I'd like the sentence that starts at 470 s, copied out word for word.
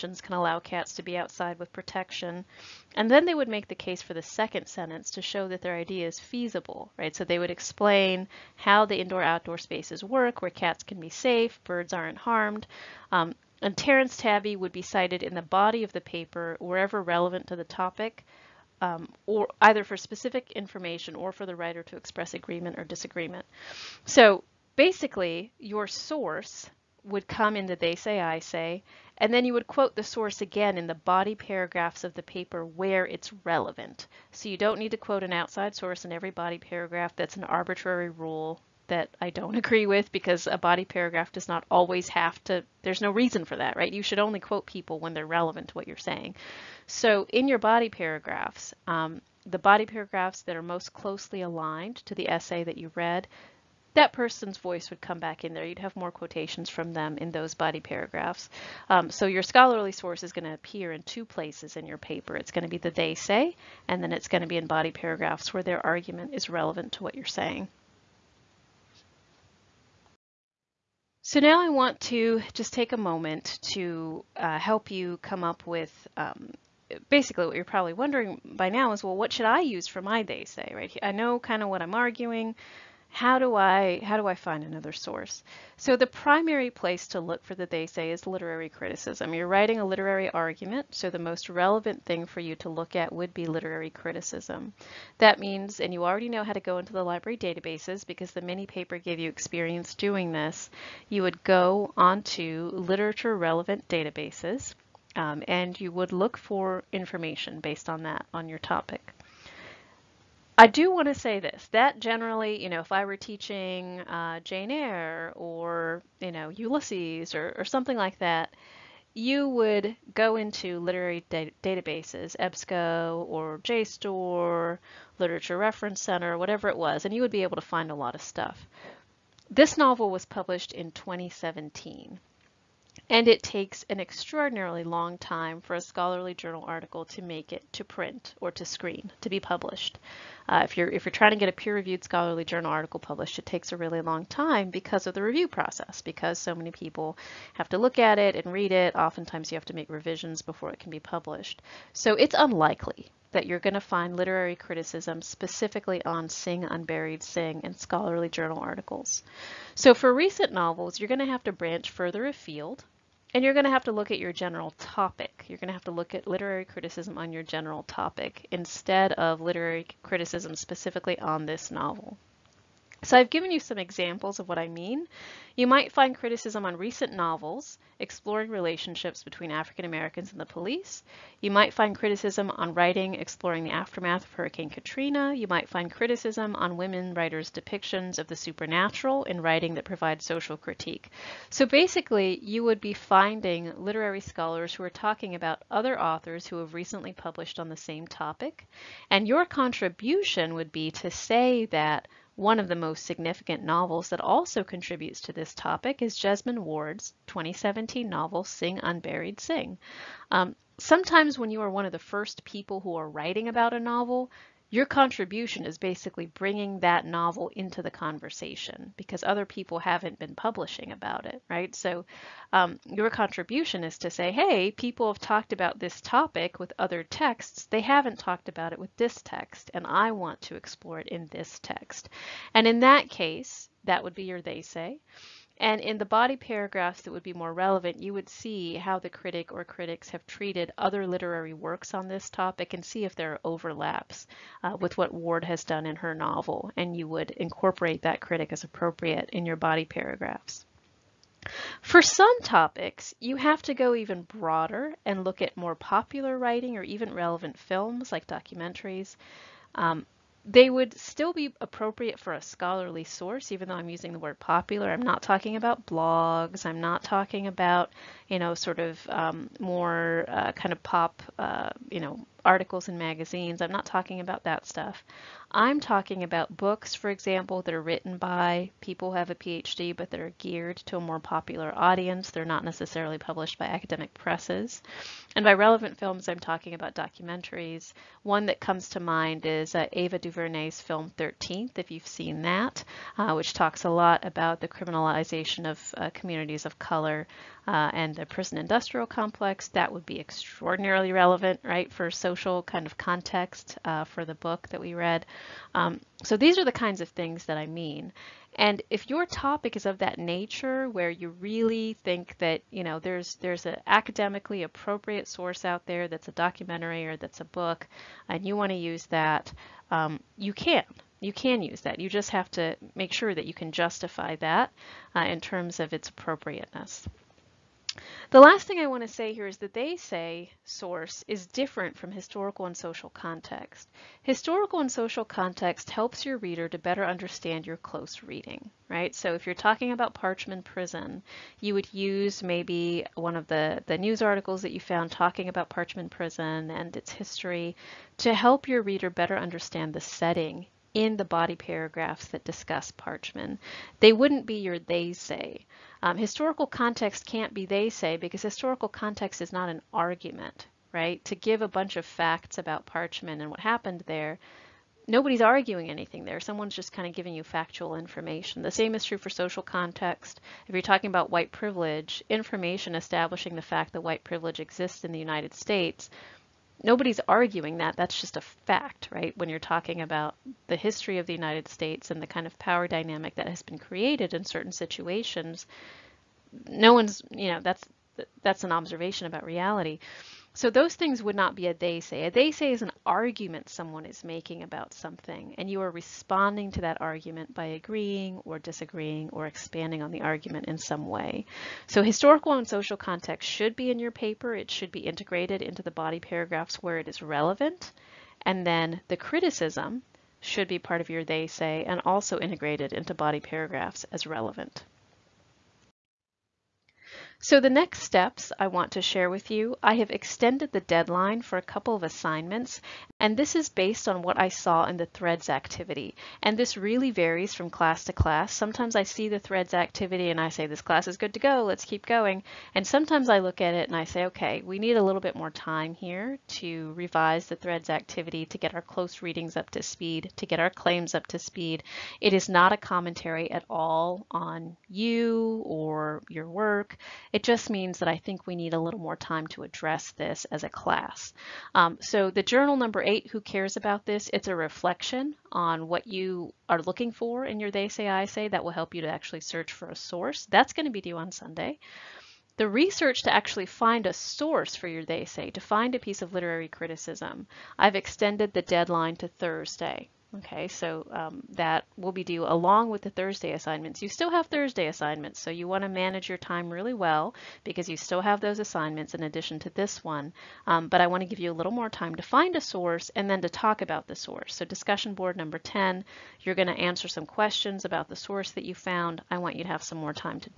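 Okay, so um, that will be due along with the Thursday assignments.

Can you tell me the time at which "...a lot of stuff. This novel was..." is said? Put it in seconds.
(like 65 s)
127 s.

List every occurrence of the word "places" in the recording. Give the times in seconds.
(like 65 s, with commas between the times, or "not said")
61 s, 86 s.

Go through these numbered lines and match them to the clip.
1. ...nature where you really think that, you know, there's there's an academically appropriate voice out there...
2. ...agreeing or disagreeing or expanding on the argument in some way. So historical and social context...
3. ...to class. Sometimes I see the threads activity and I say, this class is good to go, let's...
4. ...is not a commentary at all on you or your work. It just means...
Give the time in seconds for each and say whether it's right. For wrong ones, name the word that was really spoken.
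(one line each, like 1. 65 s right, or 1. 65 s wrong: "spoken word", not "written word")
1. 310 s wrong: "source", not "voice"
2. 397 s right
3. 428 s right
4. 442 s right.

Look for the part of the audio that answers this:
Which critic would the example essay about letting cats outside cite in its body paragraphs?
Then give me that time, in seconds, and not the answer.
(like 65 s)
13 s.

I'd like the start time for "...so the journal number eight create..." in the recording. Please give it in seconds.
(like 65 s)
452 s.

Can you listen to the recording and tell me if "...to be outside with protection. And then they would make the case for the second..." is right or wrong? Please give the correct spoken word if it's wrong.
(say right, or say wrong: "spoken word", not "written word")
right.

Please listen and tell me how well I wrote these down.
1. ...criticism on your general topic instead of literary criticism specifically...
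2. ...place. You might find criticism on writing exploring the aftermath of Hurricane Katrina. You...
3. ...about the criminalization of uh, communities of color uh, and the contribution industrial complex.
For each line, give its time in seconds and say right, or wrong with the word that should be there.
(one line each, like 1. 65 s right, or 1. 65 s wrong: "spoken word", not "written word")
1. 166 s right
2. 180 s wrong: "police", not "place"
3. 294 s wrong: "prison", not "contribution".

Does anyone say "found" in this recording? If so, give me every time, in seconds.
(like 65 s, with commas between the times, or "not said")
344 s, 488 s.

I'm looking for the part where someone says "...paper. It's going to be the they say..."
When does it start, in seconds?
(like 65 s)
61 s.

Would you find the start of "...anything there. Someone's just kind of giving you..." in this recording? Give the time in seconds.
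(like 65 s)
365 s.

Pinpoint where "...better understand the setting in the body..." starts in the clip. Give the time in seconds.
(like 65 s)
349 s.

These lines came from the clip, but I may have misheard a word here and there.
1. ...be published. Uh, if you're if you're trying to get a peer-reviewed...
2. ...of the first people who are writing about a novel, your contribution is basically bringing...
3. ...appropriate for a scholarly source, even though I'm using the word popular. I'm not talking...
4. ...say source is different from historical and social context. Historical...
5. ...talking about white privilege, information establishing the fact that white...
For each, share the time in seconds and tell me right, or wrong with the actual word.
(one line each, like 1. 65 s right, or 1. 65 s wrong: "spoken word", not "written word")
1. 139 s right
2. 211 s right
3. 261 s right
4. 329 s right
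5. 370 s right.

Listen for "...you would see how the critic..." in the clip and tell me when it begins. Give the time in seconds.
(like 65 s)
237 s.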